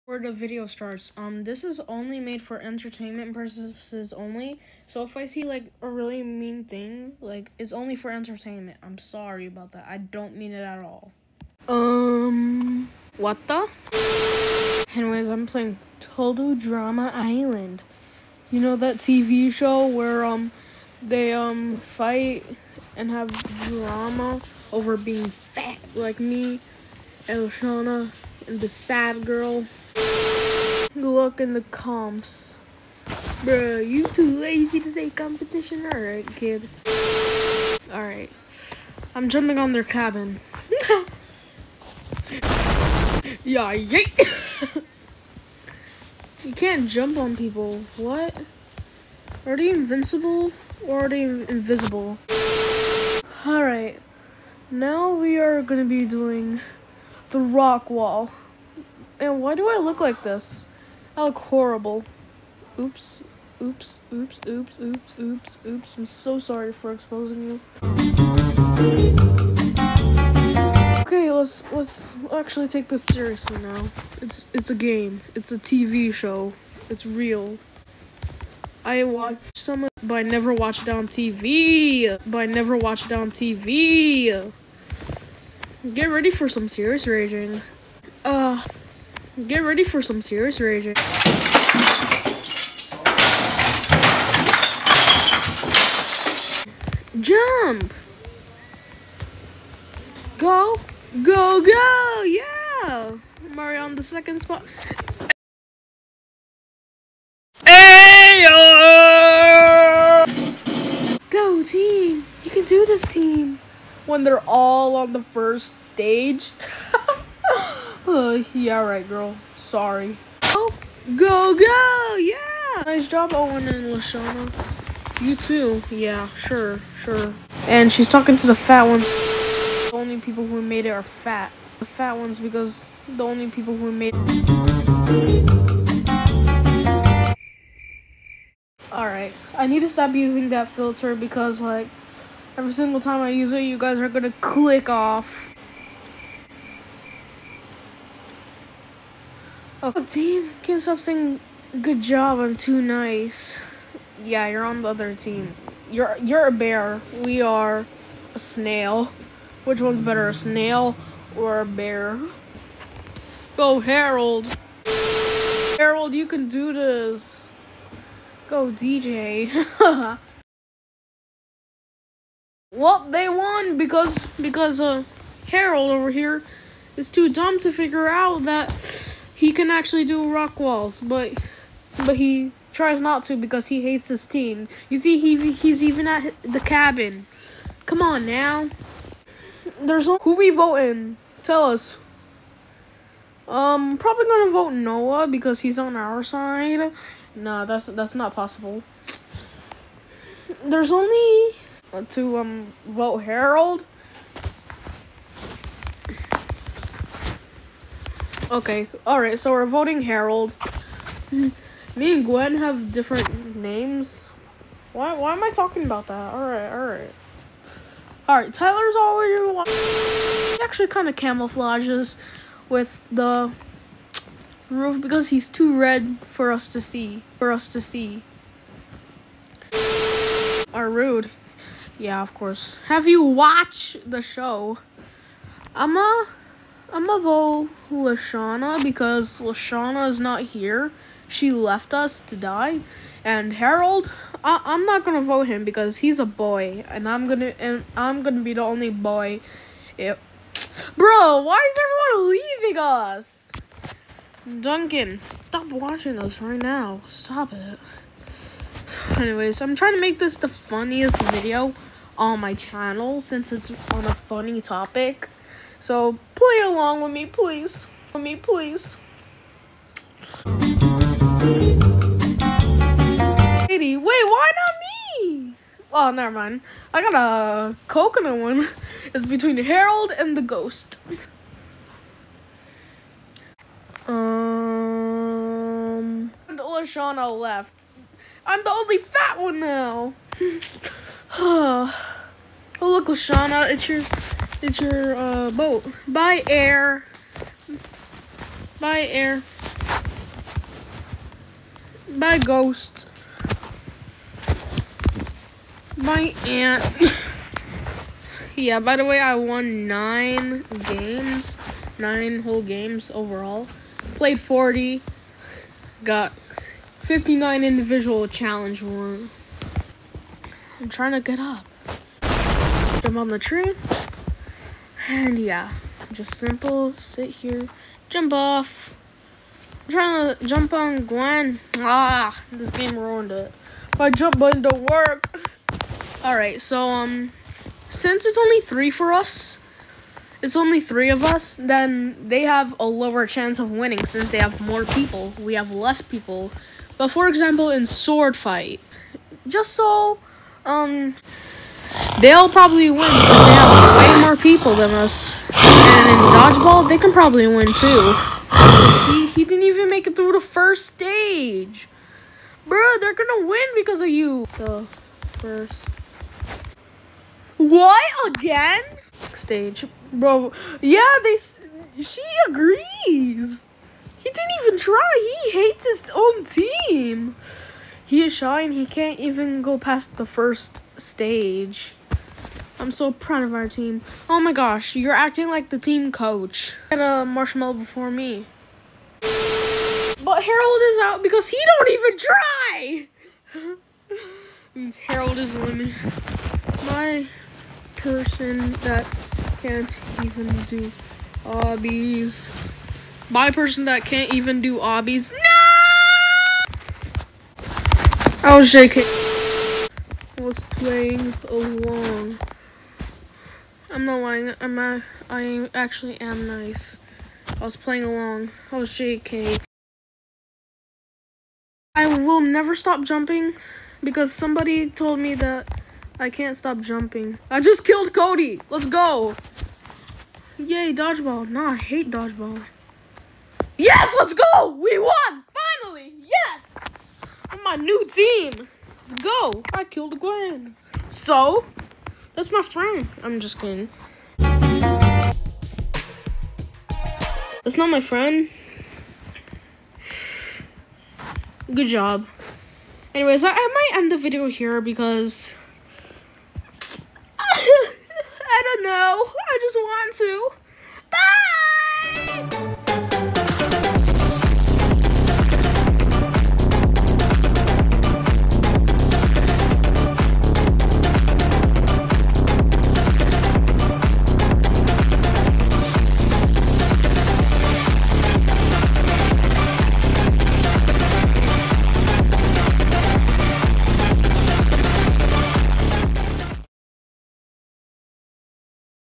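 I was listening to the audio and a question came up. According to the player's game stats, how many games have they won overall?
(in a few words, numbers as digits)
9.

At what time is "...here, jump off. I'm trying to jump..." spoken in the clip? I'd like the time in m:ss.
5:27.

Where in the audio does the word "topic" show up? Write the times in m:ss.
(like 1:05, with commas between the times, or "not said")
4:24.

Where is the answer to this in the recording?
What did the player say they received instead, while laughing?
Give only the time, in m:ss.
4:37.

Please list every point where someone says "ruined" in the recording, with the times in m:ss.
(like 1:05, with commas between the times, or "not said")
5:32.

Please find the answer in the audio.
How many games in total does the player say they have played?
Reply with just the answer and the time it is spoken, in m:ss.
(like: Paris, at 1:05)
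40, at 5:14.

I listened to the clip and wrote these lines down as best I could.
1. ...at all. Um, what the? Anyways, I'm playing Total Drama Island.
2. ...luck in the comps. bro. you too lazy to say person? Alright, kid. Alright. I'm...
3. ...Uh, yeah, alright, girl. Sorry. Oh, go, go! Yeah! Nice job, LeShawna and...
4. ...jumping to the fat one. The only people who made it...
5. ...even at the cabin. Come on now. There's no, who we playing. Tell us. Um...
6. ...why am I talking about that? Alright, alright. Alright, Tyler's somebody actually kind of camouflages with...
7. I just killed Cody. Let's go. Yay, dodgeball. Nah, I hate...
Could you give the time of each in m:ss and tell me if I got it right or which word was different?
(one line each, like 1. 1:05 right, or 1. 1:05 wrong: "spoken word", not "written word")
1. 0:10 right
2. 0:31 wrong: "competition", not "person"
3. 1:58 wrong: "Owen", not "LeShawna"
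4. 2:08 wrong: "talking", not "jumping"
5. 3:05 wrong: "voting", not "playing"
6. 3:35 wrong: "already", not "somebody"
7. 7:07 right.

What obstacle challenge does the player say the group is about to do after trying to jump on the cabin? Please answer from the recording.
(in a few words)
Rock wall.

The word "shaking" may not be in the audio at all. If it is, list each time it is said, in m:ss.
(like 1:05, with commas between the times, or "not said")
6:48.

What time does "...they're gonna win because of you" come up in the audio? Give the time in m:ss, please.
6:02.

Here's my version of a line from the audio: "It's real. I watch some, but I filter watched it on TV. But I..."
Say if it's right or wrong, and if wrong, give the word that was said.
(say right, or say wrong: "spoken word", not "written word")
wrong: "never", not "filter".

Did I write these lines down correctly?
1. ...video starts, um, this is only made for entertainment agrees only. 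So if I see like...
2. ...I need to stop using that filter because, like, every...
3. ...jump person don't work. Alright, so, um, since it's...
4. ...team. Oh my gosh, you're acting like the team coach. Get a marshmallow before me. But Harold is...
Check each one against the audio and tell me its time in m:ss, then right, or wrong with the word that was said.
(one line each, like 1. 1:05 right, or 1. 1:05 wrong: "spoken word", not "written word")
1. 0:00 wrong: "purposes", not "agrees"
2. 2:19 right
3. 5:34 wrong: "button", not "person"
4. 6:23 right.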